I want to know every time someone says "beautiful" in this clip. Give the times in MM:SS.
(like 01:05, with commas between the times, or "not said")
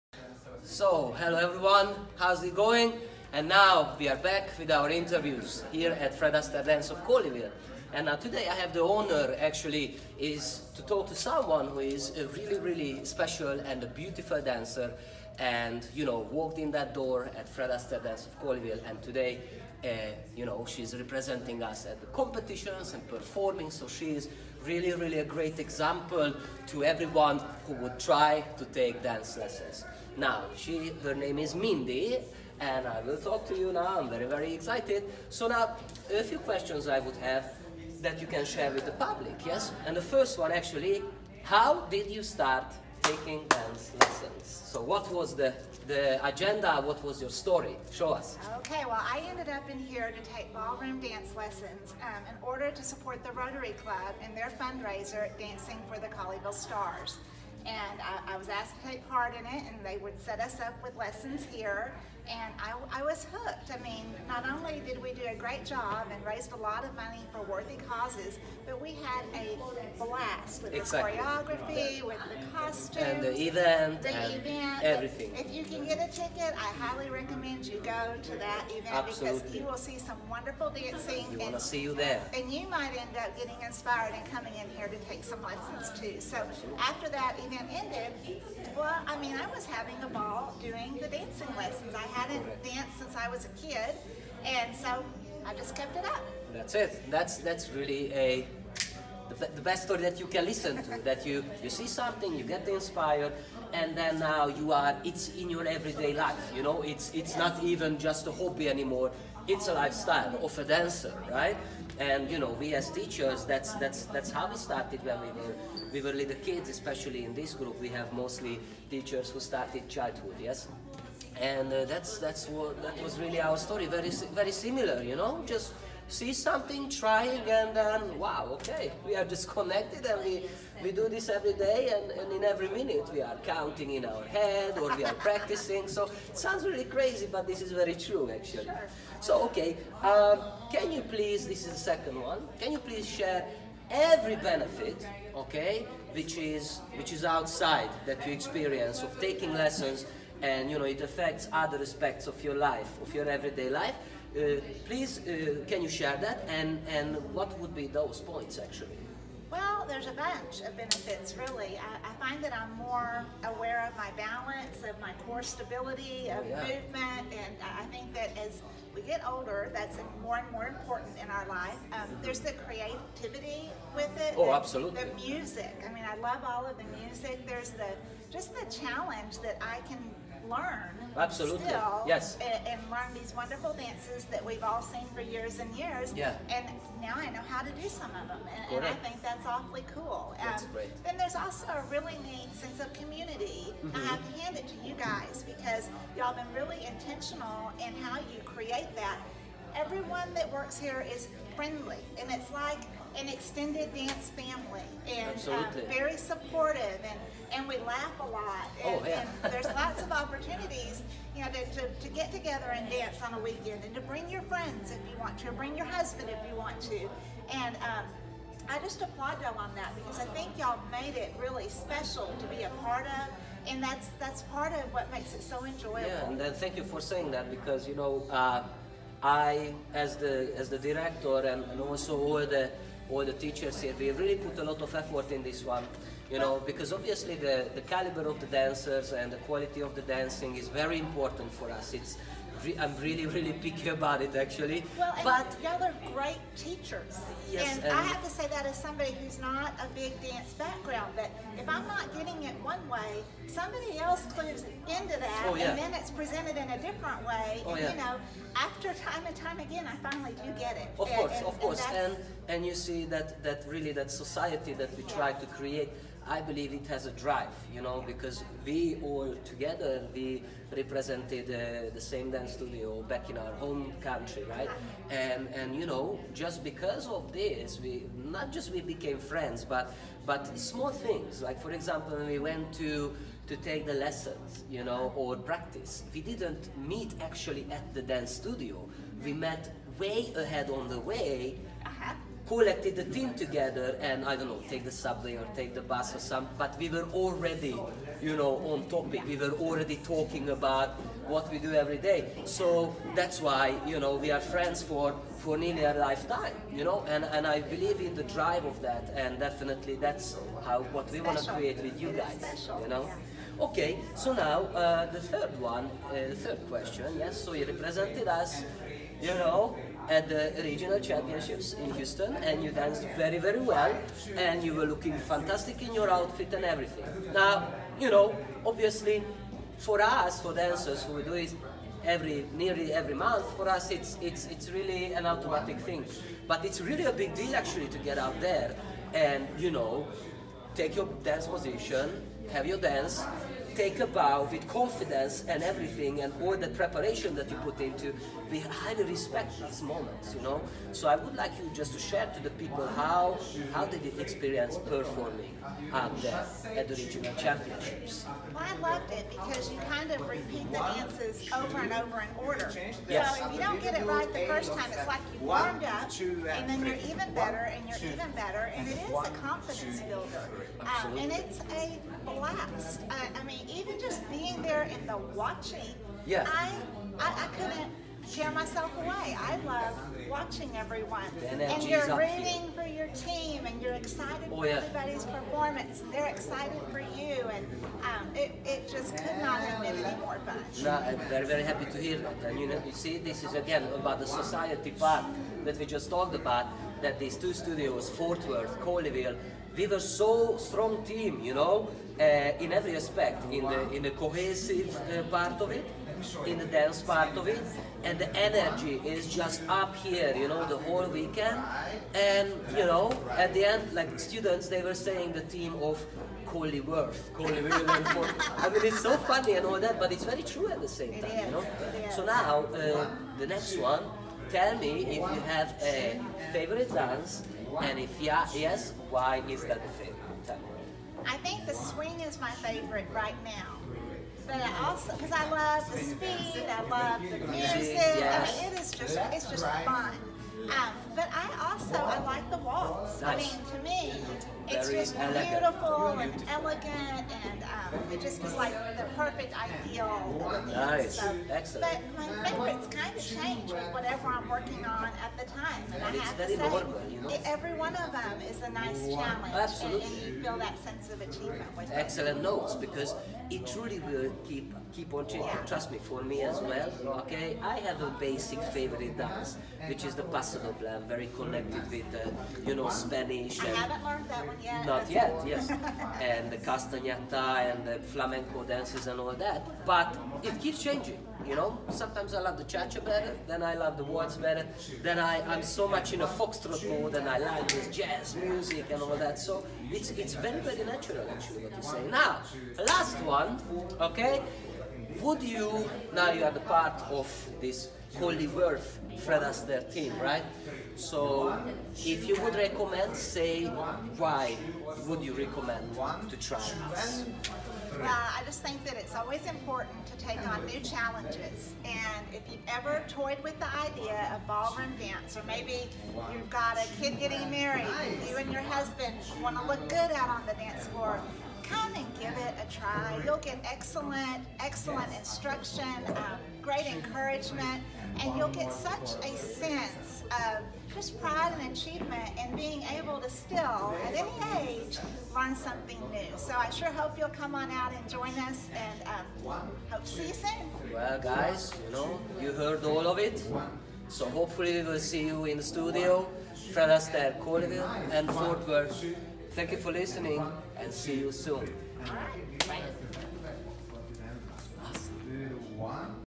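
00:13, 07:25.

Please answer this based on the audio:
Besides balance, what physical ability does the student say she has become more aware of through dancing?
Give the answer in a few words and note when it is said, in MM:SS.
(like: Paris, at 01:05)
core stability, at 02:45.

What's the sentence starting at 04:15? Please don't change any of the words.
and then it's presented in a different way.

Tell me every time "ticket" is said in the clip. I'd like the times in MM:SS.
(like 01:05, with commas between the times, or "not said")
01:16.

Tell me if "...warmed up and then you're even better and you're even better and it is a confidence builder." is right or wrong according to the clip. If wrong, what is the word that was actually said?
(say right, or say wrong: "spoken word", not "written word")
right.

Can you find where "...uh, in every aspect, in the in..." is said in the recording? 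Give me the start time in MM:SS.
06:42.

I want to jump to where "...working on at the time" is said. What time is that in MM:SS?
07:34.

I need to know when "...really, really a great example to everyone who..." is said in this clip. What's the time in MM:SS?
00:24.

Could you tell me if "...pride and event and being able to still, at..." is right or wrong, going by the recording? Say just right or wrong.
wrong.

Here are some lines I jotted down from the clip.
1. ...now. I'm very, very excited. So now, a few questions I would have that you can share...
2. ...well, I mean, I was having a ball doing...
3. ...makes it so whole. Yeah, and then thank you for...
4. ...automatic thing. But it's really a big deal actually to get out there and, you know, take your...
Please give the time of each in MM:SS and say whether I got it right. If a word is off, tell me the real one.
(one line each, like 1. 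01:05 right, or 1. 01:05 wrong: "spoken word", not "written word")
1. 00:33 right
2. 01:28 right
3. 03:45 wrong: "enjoyable", not "whole"
4. 05:35 right.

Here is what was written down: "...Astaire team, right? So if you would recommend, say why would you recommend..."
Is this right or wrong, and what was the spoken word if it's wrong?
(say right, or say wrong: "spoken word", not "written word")
right.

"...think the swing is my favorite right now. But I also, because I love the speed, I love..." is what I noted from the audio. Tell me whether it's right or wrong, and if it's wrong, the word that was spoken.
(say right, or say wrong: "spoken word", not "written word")
right.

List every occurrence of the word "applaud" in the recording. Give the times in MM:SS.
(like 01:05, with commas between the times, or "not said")
03:39.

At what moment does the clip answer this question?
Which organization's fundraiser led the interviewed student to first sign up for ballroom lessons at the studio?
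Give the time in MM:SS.
00:53.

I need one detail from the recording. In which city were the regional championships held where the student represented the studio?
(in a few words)
Houston.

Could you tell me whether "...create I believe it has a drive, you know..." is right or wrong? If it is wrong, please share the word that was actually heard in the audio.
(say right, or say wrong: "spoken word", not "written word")
right.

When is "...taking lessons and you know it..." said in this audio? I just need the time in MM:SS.
02:29.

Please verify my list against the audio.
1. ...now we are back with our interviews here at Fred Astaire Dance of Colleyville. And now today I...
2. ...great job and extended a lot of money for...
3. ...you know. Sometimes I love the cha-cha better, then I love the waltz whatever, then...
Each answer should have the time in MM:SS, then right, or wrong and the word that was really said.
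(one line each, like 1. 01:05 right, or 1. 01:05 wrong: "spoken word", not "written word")
1. 00:03 right
2. 01:05 wrong: "raised", not "extended"
3. 08:01 wrong: "better", not "whatever".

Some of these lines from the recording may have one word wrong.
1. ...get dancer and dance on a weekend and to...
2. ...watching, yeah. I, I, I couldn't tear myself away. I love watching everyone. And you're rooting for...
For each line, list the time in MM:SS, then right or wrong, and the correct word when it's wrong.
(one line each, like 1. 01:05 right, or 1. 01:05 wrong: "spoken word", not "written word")
1. 03:32 wrong: "together", not "dancer"
2. 06:15 right.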